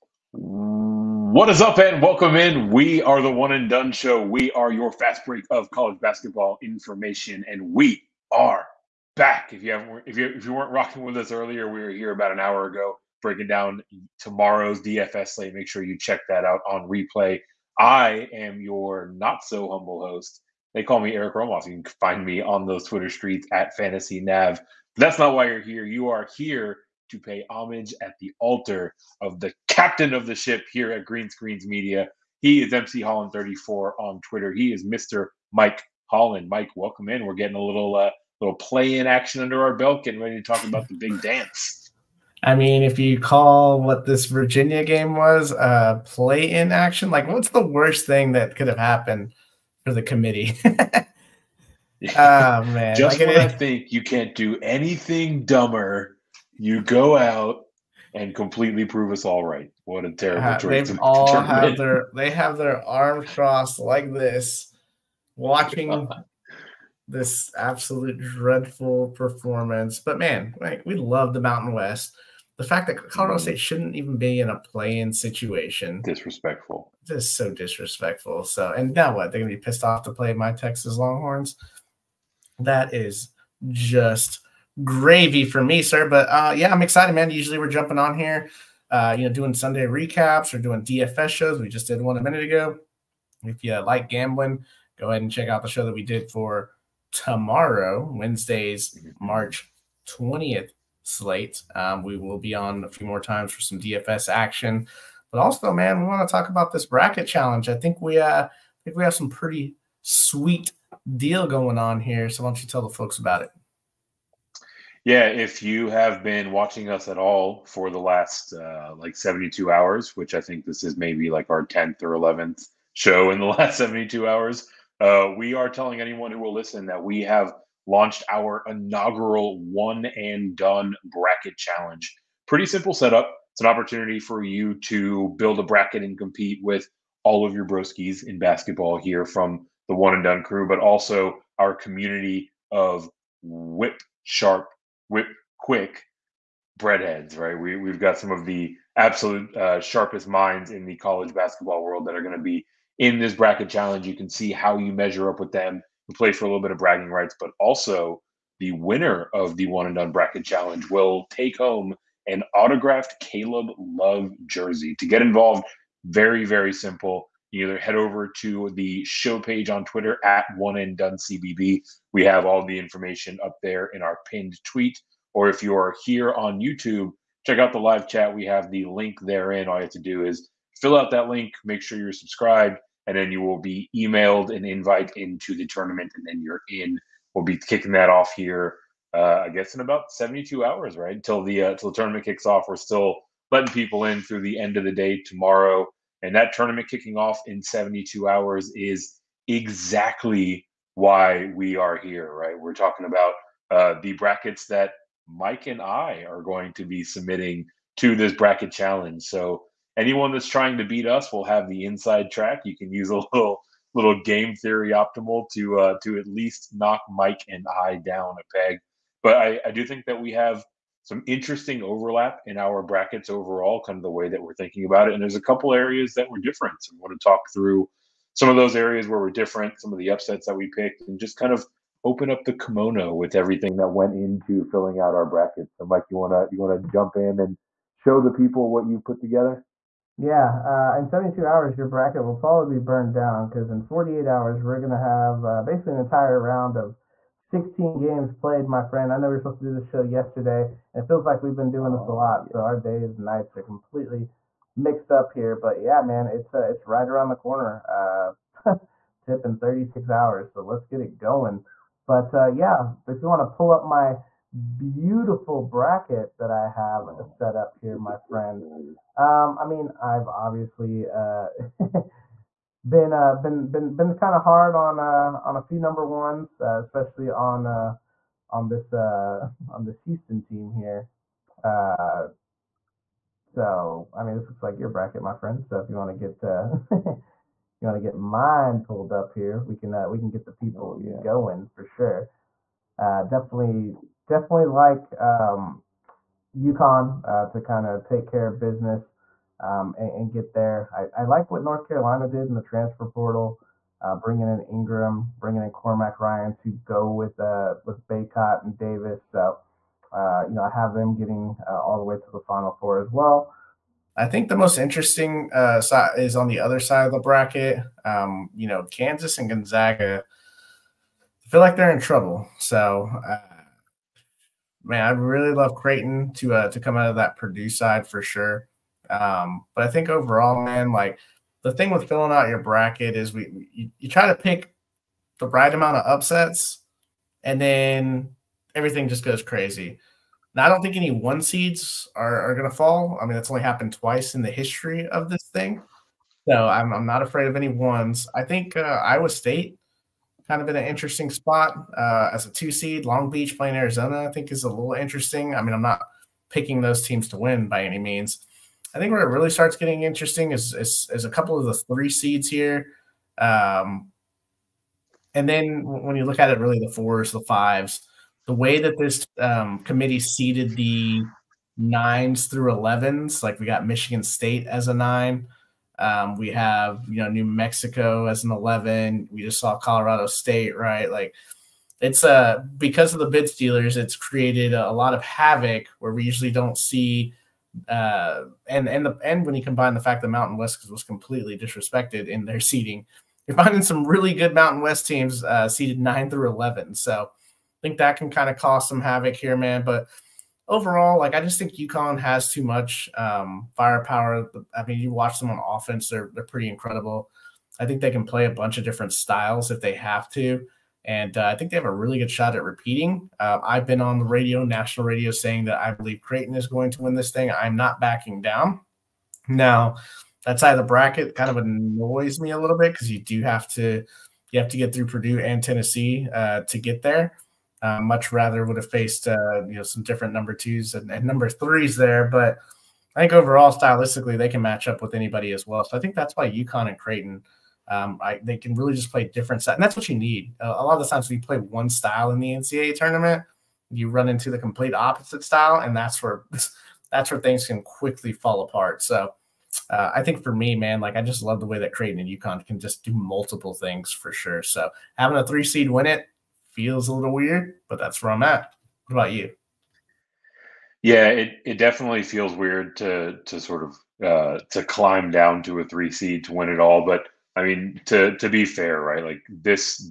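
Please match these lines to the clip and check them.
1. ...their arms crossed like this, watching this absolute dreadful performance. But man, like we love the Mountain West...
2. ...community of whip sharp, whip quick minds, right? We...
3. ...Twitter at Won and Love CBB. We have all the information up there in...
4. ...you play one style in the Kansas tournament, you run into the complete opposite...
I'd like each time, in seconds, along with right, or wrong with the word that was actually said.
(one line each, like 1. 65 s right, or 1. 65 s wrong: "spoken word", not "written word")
1. 62 s right
2. 141 s wrong: "breadheads", not "minds"
3. 169 s wrong: "Done", not "Love"
4. 441 s wrong: "NCAA", not "Kansas".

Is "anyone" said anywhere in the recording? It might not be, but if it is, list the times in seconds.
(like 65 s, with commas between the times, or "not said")
126 s, 209 s.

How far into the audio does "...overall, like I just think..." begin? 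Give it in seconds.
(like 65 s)
400 s.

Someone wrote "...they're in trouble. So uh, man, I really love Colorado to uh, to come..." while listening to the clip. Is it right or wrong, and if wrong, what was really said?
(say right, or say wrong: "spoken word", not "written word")
wrong: "Creighton", not "Colorado".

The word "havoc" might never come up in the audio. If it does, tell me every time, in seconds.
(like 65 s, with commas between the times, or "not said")
385 s, 399 s.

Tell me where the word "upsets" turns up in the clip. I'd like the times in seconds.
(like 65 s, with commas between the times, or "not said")
230 s, 336 s.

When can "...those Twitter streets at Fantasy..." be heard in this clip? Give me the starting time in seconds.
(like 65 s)
22 s.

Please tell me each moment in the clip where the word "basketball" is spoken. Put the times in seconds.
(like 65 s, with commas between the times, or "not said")
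5 s, 138 s, 151 s.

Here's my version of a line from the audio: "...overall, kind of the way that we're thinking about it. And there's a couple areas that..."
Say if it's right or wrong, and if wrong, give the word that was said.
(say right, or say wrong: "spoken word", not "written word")
right.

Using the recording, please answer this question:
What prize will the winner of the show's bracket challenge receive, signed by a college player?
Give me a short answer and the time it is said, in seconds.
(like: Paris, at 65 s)
Autographed Caleb Love jersey, at 162 s.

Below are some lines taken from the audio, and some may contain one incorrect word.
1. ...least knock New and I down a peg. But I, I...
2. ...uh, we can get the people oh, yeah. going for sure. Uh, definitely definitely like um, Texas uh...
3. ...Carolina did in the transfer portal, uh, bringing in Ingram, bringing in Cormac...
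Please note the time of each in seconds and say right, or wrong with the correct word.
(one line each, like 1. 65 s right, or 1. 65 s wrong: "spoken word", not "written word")
1. 216 s wrong: "Mike", not "New"
2. 289 s wrong: "UConn", not "Texas"
3. 301 s right.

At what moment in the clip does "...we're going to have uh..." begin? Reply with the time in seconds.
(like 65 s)
244 s.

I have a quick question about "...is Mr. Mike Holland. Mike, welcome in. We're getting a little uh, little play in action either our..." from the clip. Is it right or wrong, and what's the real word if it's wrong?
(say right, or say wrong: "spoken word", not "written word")
wrong: "under", not "either".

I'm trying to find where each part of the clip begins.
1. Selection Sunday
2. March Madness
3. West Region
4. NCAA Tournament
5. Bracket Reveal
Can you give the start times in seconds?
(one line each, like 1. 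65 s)
1. 177 s
2. 307 s
3. 458 s
4. 67 s
5. 386 s.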